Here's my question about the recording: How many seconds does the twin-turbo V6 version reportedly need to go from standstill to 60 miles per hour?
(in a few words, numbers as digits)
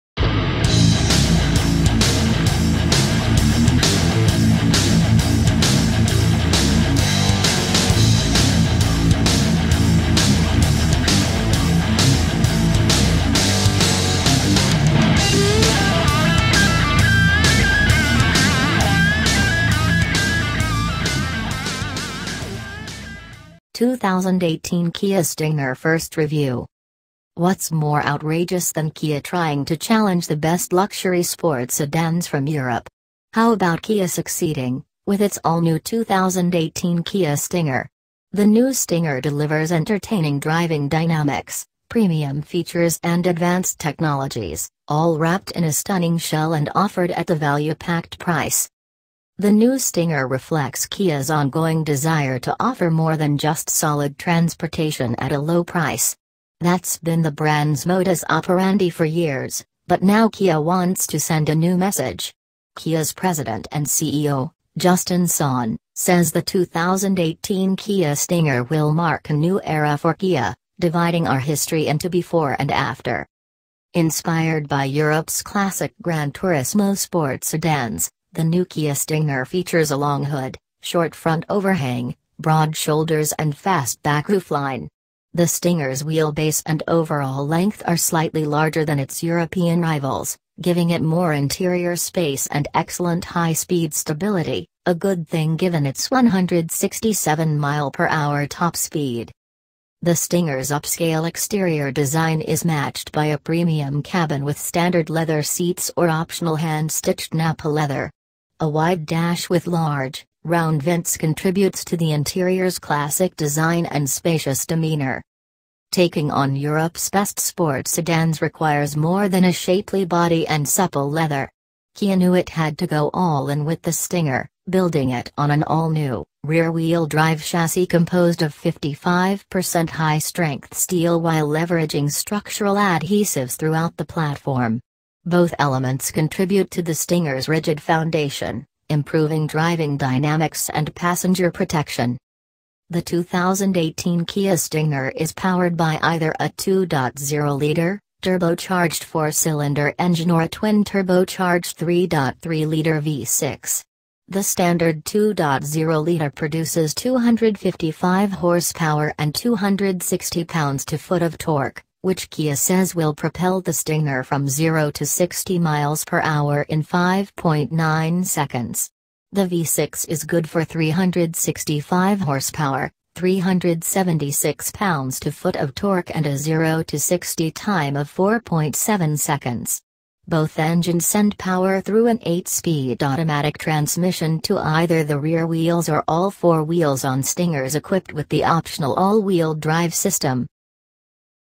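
4.7 seconds.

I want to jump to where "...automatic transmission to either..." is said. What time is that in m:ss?
3:03.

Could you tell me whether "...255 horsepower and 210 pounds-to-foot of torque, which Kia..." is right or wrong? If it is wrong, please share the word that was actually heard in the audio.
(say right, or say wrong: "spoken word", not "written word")
wrong: "260", not "210".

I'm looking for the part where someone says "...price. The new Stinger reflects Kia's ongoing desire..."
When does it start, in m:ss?
0:48.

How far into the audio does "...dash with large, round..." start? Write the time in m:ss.
1:49.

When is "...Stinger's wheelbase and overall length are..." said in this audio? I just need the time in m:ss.
1:25.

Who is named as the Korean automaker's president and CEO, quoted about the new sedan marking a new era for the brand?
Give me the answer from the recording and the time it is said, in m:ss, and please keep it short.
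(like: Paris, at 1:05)
Justin Son, at 1:04.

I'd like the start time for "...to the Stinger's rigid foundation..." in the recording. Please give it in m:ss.
2:16.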